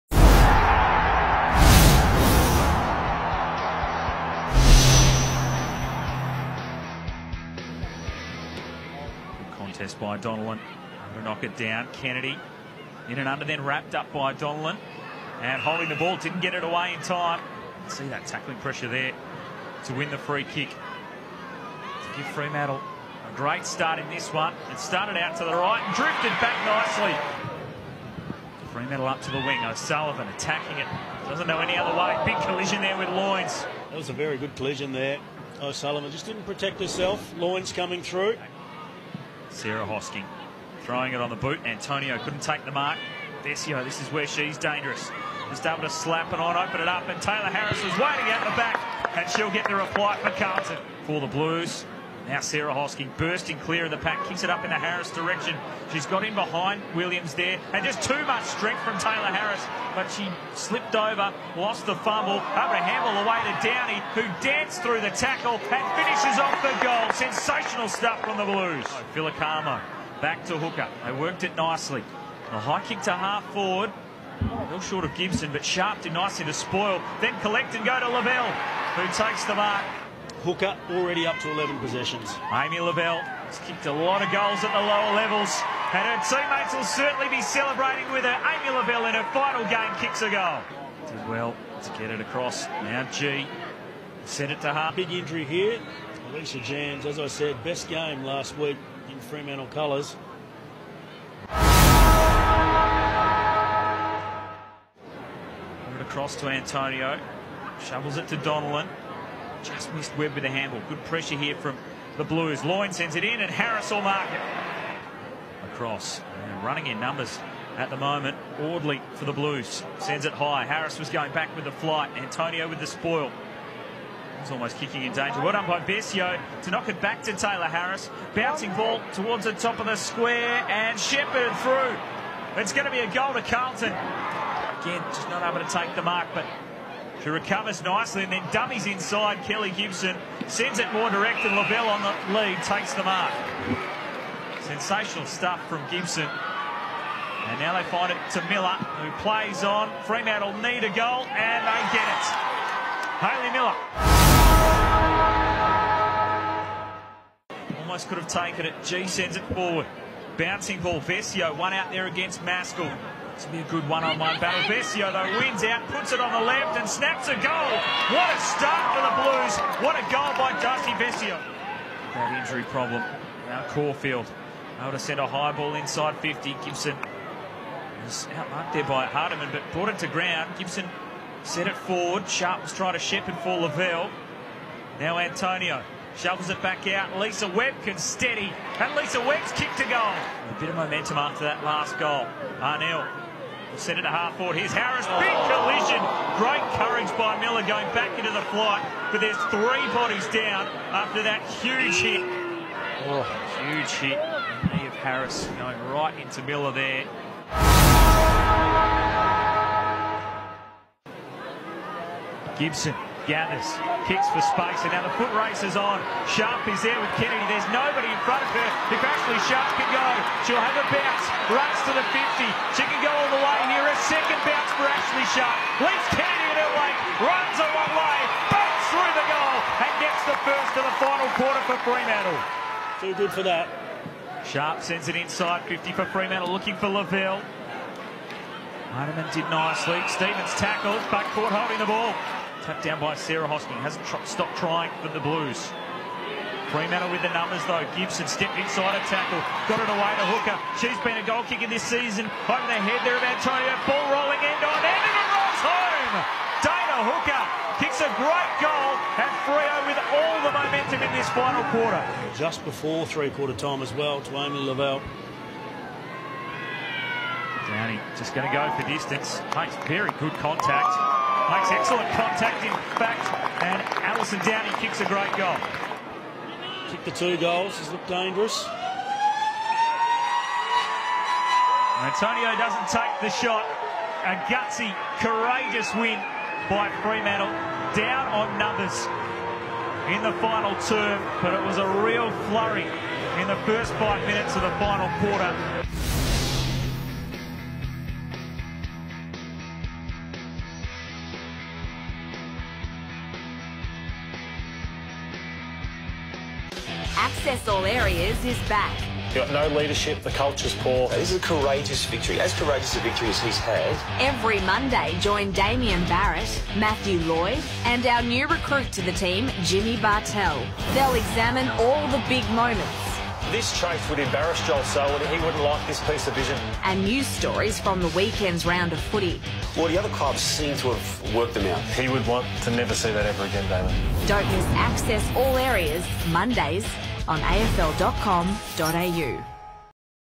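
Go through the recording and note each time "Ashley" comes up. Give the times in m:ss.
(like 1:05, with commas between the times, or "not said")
3:38, 3:44.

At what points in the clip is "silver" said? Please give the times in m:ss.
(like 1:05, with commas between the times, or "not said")
not said.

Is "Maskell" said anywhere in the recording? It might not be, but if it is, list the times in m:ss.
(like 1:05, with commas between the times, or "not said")
2:42.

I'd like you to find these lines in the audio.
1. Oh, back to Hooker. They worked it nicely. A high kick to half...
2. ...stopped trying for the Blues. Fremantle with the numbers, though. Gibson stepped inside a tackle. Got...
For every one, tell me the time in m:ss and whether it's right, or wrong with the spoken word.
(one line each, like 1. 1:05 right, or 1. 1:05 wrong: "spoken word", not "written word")
1. 1:08 right
2. 4:04 right.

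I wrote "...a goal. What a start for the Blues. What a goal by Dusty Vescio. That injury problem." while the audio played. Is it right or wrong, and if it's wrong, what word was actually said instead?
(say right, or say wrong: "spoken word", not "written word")
right.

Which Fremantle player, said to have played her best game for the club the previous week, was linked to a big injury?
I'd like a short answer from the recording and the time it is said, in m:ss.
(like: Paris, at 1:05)
Alicia Janz, at 1:36.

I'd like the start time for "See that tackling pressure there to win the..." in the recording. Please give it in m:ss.
0:17.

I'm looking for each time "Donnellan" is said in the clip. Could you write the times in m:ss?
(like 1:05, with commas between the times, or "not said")
0:10, 0:14, 1:48.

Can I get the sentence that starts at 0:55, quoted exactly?
She's got in behind Williams there, and just too much strength from Tayla Harris, but she slipped over, lost the fumble.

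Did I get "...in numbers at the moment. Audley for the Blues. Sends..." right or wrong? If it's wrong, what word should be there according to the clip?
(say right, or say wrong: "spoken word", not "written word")
right.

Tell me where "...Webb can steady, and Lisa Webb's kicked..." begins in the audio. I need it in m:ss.
3:07.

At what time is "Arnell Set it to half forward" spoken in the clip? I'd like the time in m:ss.
3:12.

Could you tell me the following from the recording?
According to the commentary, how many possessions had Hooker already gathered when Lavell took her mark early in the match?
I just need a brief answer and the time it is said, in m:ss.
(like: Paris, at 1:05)
11, at 1:21.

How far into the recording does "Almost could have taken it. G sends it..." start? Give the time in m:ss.
2:37.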